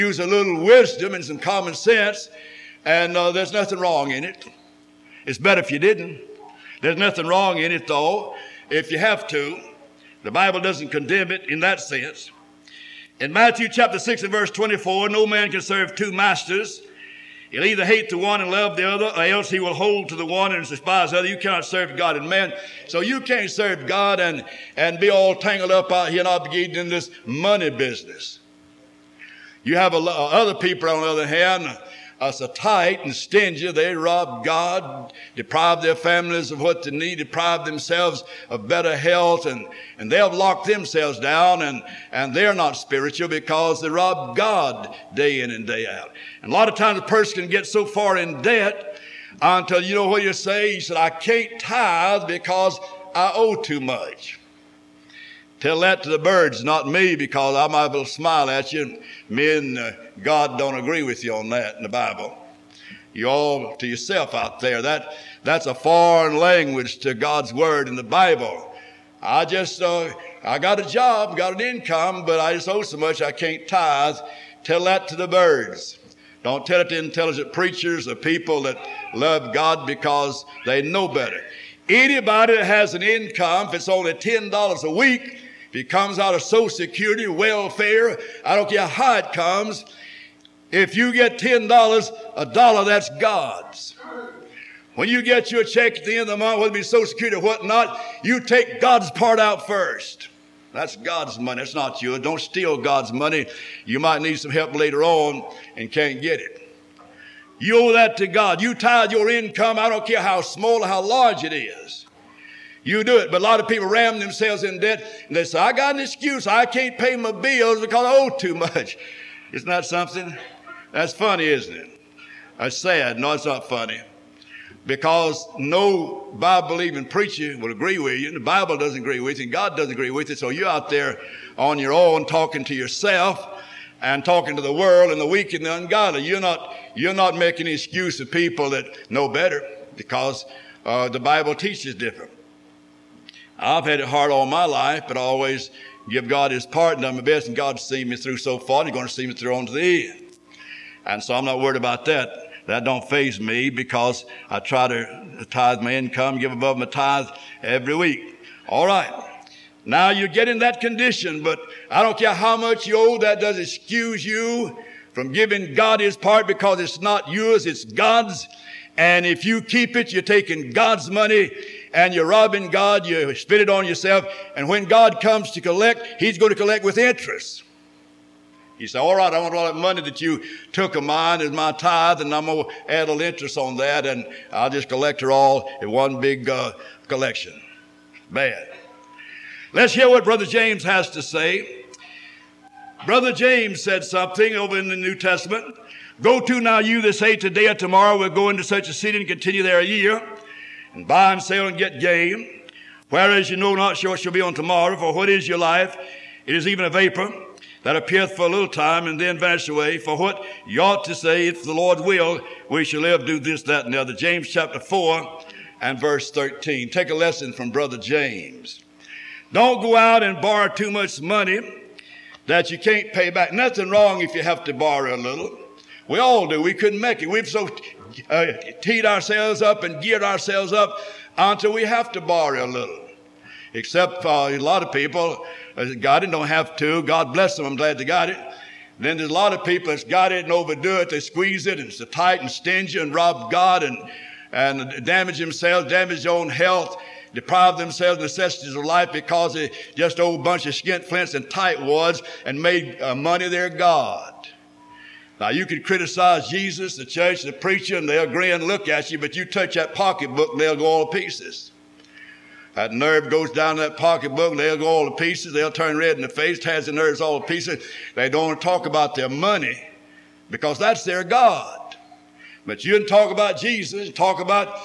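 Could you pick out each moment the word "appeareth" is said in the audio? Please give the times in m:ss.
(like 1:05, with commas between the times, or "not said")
3:27.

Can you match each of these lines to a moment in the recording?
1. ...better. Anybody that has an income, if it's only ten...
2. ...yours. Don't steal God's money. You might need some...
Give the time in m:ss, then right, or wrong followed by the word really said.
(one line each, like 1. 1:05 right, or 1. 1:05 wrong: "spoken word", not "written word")
1. 1:21 right
2. 1:42 right.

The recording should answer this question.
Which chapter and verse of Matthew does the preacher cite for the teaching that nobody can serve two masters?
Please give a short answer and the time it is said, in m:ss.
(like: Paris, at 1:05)
chapter 6, verse 24, at 0:13.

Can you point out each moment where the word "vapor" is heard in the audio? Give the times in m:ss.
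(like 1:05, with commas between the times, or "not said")
3:26.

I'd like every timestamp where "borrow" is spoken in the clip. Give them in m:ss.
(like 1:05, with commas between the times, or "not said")
3:40, 3:44, 3:52.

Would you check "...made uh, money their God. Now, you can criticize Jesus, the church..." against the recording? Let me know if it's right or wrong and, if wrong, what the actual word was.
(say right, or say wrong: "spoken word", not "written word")
right.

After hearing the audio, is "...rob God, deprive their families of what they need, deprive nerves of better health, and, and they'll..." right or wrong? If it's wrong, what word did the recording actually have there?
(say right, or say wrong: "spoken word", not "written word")
wrong: "themselves", not "nerves".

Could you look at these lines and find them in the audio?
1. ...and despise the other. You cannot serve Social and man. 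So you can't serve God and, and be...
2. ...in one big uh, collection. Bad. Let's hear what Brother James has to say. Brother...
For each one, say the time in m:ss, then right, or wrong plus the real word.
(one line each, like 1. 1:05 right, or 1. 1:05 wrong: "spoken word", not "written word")
1. 0:20 wrong: "God", not "Social"
2. 3:05 right.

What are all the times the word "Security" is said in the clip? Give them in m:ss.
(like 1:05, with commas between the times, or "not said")
1:26, 1:37.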